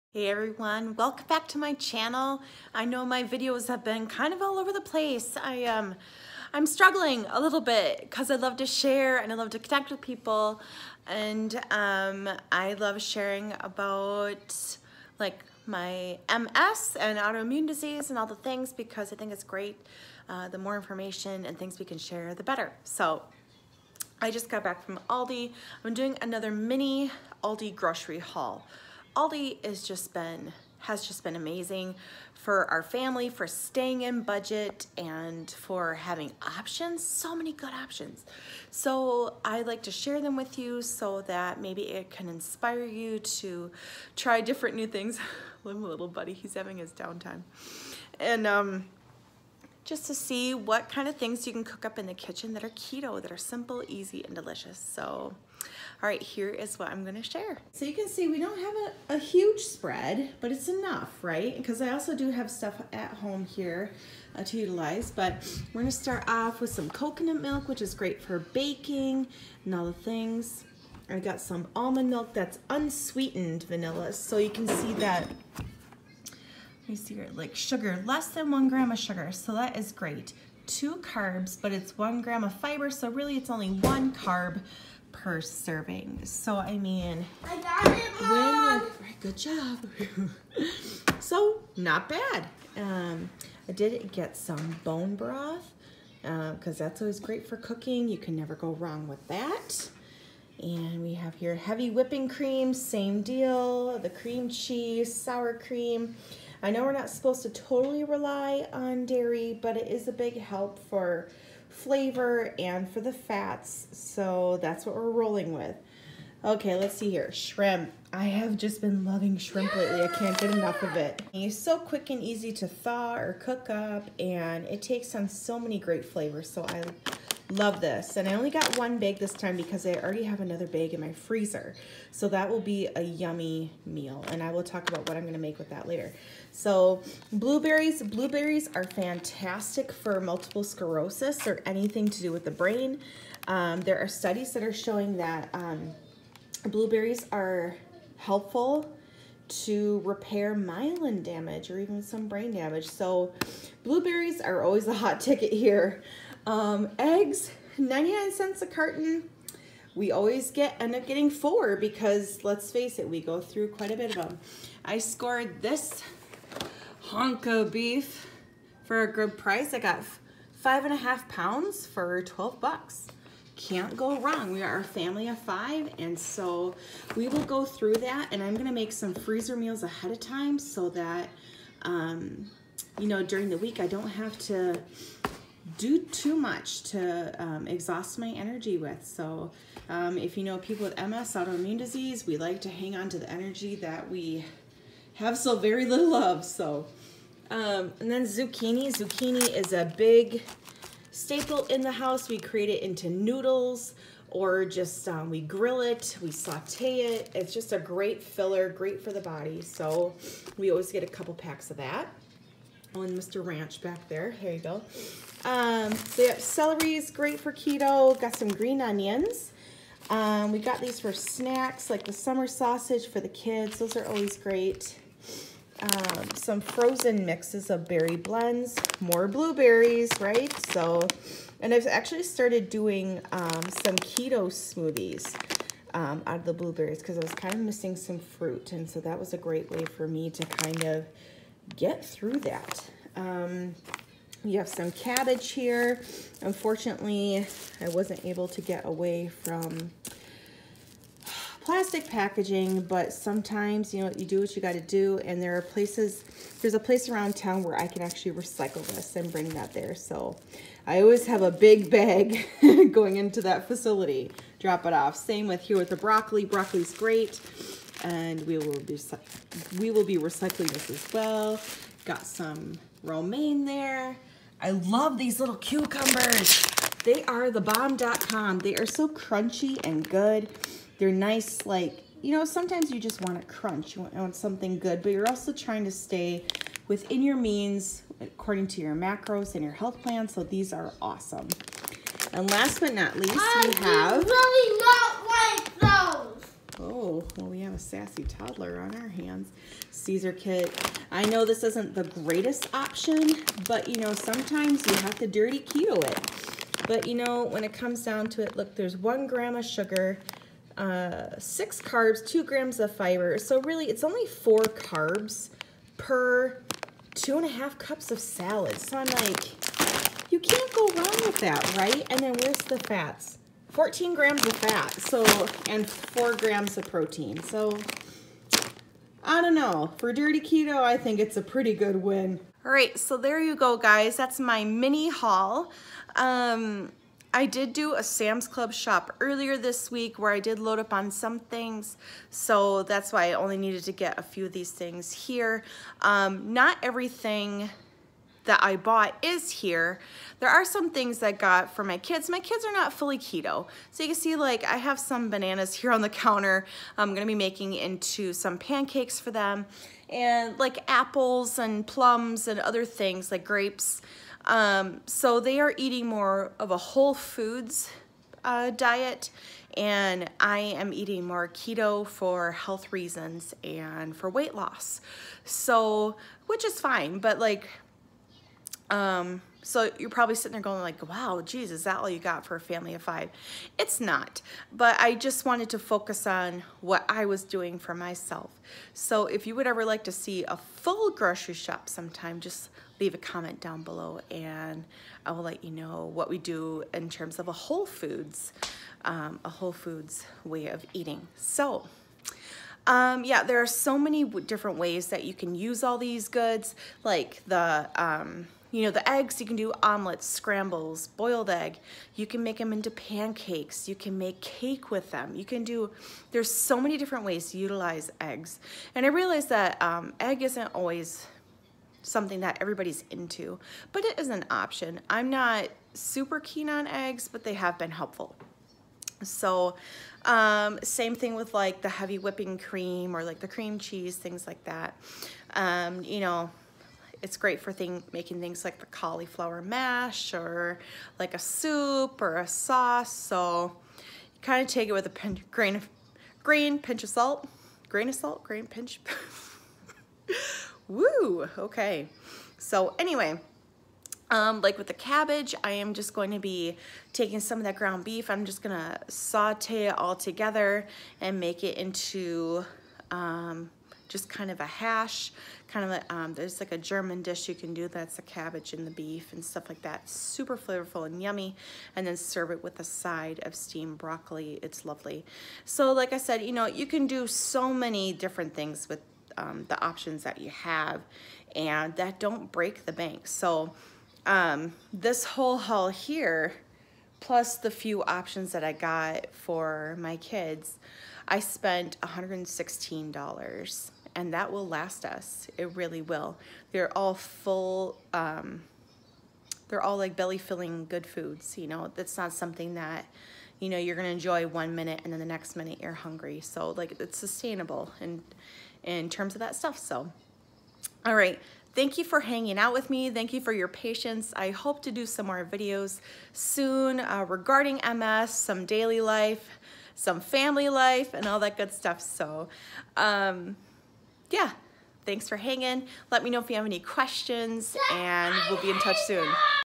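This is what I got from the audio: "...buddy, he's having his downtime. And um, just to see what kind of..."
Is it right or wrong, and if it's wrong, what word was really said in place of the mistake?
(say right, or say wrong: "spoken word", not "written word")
right.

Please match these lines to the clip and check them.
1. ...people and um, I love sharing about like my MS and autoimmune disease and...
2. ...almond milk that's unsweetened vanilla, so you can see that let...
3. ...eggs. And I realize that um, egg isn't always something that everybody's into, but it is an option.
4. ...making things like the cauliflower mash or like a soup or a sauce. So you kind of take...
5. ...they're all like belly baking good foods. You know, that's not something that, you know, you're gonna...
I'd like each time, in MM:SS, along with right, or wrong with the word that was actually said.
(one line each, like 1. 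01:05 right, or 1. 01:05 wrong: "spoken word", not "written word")
1. 00:10 right
2. 01:11 right
3. 06:58 right
4. 07:18 right
5. 08:19 wrong: "filling", not "baking".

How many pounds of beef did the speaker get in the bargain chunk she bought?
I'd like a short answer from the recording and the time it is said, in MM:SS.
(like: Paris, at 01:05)
5.5 pounds, at 02:50.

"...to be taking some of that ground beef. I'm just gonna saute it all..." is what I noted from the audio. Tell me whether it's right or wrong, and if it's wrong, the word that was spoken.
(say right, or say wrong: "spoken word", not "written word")
right.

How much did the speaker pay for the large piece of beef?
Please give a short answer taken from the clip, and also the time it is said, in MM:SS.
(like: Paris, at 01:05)
$12, at 02:52.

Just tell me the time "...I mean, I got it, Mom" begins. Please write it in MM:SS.
01:26.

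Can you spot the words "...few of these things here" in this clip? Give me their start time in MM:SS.
05:44.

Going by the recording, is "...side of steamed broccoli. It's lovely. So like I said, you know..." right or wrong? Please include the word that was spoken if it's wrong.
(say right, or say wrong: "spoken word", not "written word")
right.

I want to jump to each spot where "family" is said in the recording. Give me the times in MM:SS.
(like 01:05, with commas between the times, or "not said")
00:32, 02:54, 06:22, 08:40.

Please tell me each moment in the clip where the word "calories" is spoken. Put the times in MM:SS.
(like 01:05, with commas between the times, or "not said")
not said.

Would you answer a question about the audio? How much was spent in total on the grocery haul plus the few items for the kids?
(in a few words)
$116.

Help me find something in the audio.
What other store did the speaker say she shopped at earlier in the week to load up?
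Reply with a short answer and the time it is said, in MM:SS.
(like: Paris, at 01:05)
Sam's Club, at 05:38.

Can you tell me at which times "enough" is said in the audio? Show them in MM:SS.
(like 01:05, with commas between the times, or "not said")
01:00, 02:00.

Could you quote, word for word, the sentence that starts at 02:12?
So that will be a yummy meal.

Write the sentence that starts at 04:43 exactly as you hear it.
You want something good, but you're also trying to stay within your means according to your macros and your health plan.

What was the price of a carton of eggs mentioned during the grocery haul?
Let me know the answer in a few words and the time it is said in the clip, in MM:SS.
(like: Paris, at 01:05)
99 cents, at 02:37.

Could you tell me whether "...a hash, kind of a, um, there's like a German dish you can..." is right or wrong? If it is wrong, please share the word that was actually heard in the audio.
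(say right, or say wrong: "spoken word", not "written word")
right.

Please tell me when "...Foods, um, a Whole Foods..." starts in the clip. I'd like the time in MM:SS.
06:37.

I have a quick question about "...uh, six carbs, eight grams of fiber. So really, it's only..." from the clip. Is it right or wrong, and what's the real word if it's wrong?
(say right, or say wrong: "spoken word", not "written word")
wrong: "two", not "eight".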